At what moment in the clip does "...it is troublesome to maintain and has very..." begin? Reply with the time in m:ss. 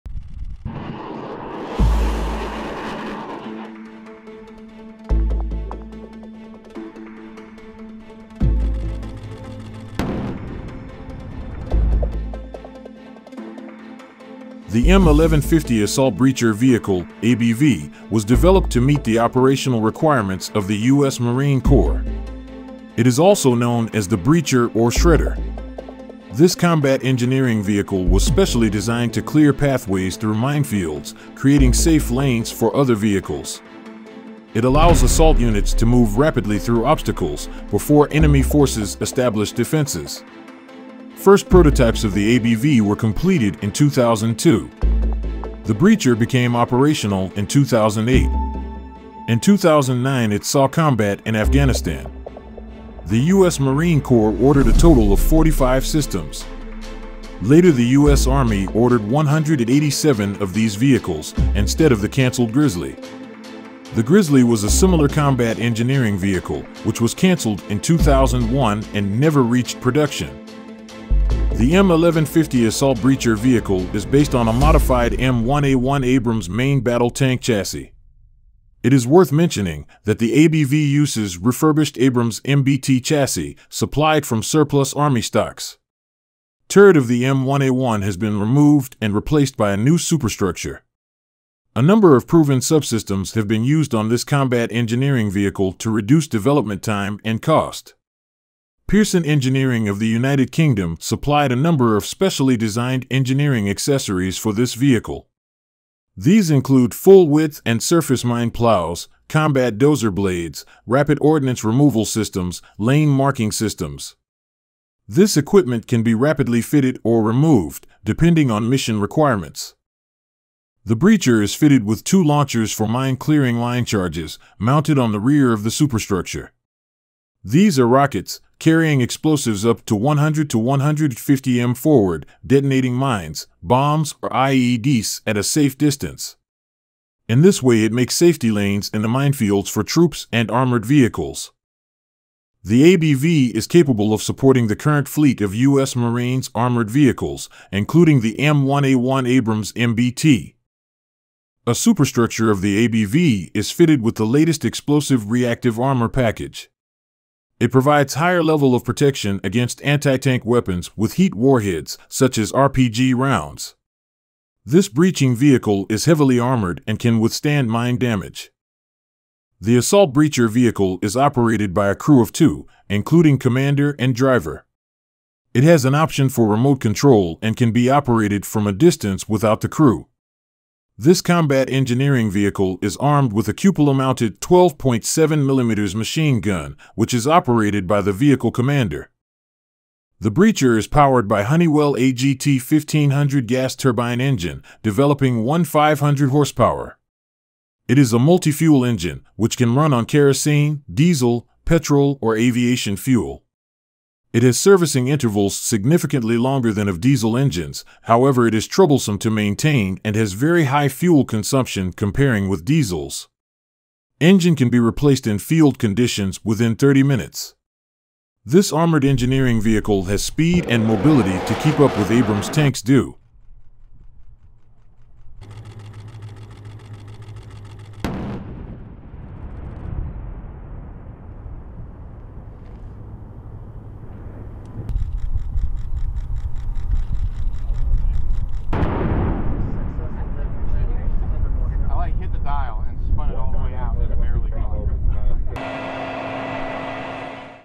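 3:28.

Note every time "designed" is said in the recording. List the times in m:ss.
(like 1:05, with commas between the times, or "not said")
0:28, 1:42.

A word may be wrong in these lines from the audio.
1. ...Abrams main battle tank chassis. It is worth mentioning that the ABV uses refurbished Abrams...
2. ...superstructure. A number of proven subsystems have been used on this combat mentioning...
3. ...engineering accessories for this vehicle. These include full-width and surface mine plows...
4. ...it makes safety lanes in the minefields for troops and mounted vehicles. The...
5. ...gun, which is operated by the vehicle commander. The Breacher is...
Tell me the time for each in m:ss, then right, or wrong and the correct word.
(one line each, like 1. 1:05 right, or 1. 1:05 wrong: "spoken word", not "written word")
1. 1:16 right
2. 1:29 wrong: "engineering", not "mentioning"
3. 1:43 right
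4. 2:17 wrong: "armored", not "mounted"
5. 3:06 right.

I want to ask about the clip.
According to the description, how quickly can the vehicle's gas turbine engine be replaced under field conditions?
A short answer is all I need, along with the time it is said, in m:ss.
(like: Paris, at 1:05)
30 minutes, at 3:36.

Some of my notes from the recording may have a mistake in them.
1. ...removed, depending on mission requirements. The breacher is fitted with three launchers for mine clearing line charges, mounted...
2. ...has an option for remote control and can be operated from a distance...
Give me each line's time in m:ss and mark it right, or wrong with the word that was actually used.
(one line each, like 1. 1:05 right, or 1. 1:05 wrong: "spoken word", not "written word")
1. 1:57 wrong: "two", not "three"
2. 2:55 right.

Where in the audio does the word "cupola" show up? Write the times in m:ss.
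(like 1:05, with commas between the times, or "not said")
3:03.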